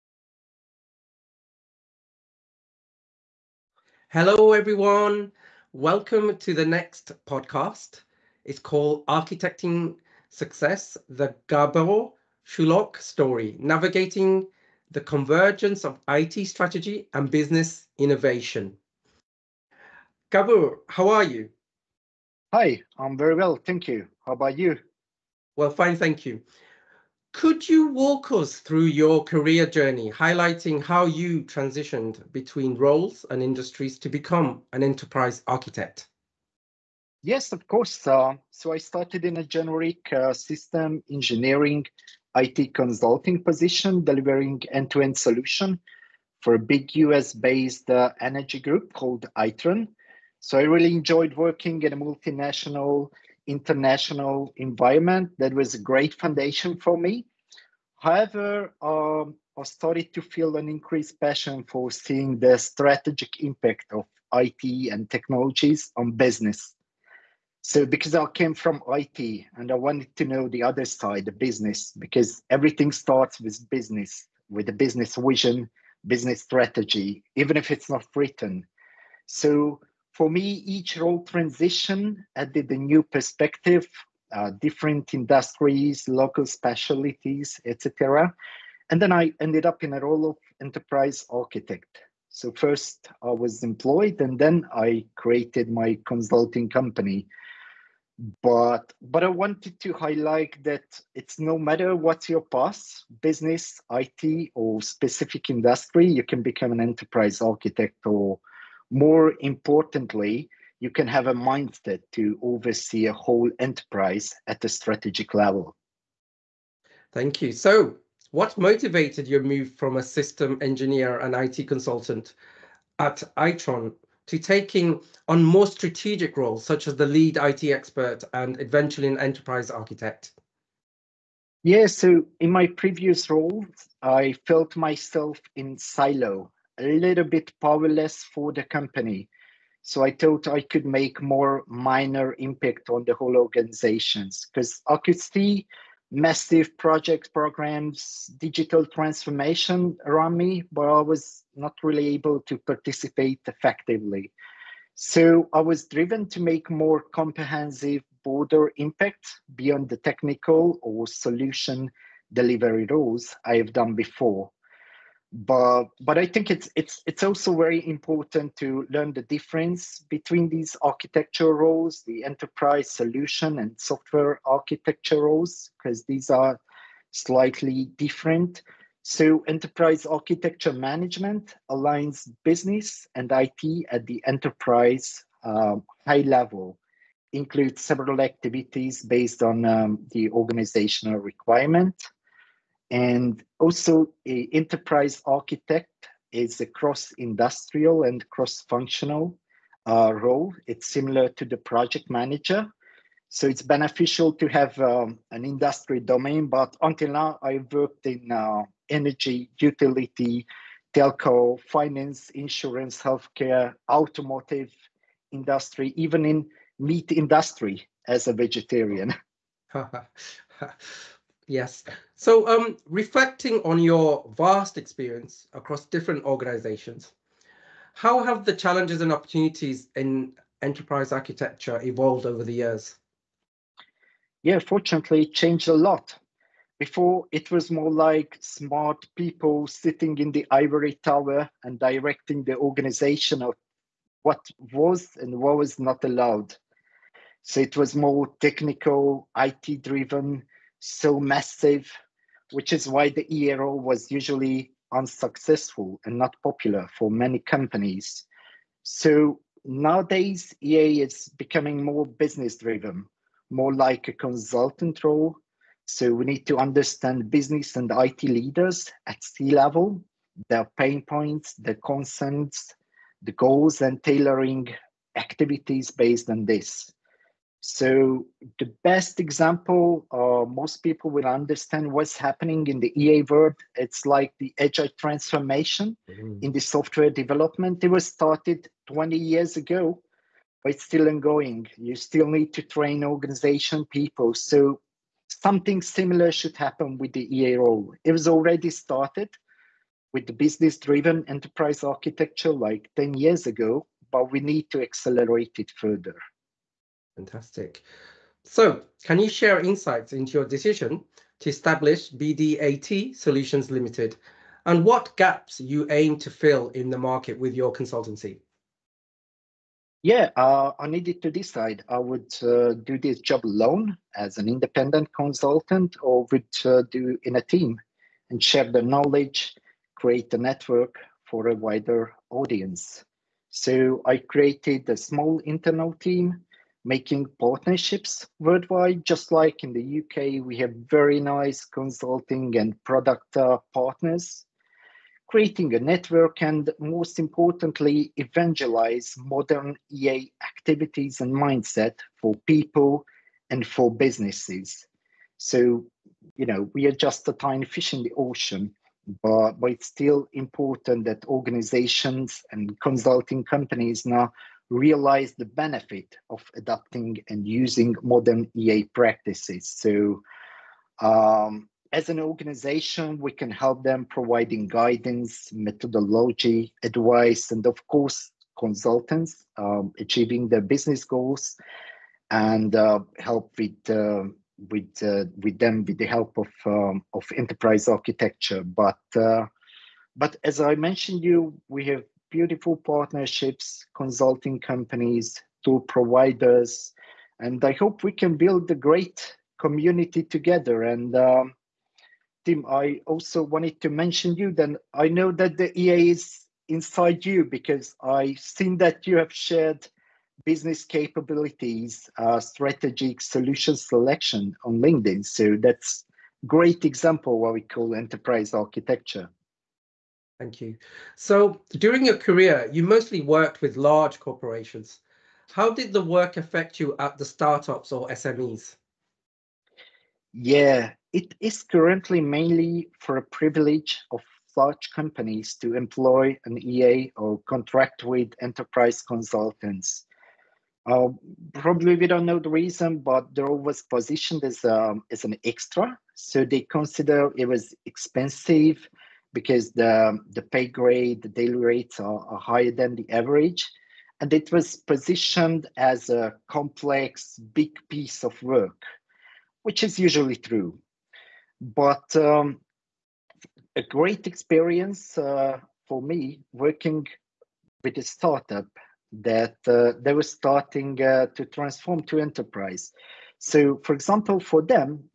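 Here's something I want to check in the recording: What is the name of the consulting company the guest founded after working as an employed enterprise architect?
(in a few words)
BDAT Solutions Limited.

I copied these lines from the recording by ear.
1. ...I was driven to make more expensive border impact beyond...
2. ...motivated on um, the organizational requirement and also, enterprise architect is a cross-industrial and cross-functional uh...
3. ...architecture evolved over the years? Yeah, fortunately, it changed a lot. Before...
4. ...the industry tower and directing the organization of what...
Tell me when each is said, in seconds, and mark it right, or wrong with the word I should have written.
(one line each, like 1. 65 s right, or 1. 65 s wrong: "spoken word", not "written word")
1. 155 s wrong: "comprehensive", not "expensive"
2. 189 s wrong: "based", not "motivated"
3. 231 s right
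4. 240 s wrong: "ivory", not "industry".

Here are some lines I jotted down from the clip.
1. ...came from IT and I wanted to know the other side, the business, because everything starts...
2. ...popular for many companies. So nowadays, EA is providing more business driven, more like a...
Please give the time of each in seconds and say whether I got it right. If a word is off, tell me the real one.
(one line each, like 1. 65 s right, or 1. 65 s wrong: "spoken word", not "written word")
1. 68 s right
2. 256 s wrong: "becoming", not "providing".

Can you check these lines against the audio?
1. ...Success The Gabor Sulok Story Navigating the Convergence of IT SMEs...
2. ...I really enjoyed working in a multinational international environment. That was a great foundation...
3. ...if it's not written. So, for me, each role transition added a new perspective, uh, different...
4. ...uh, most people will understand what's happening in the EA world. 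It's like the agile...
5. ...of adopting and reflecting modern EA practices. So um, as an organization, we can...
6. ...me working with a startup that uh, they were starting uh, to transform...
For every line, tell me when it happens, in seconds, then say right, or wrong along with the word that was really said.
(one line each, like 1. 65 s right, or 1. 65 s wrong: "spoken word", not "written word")
1. 10 s wrong: "Strategy", not "SMEs"
2. 50 s right
3. 77 s right
4. 280 s right
5. 366 s wrong: "using", not "reflecting"
6. 466 s right.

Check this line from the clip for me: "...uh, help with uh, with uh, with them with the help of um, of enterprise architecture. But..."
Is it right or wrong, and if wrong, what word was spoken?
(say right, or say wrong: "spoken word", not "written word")
right.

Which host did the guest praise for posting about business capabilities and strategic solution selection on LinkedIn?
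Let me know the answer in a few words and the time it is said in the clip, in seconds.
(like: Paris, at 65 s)
Tim, at 402 s.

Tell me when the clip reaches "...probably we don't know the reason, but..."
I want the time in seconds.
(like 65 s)
441 s.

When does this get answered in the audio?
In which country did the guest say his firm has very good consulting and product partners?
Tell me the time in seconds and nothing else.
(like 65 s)
339 s.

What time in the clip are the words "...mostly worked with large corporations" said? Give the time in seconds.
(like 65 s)
422 s.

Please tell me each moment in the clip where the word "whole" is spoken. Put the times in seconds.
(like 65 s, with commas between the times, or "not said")
113 s, 143 s.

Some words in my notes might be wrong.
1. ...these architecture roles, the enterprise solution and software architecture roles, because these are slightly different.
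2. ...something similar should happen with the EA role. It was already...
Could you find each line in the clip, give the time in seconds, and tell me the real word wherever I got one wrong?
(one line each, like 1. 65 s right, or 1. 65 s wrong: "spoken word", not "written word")
1. 170 s right
2. 295 s right.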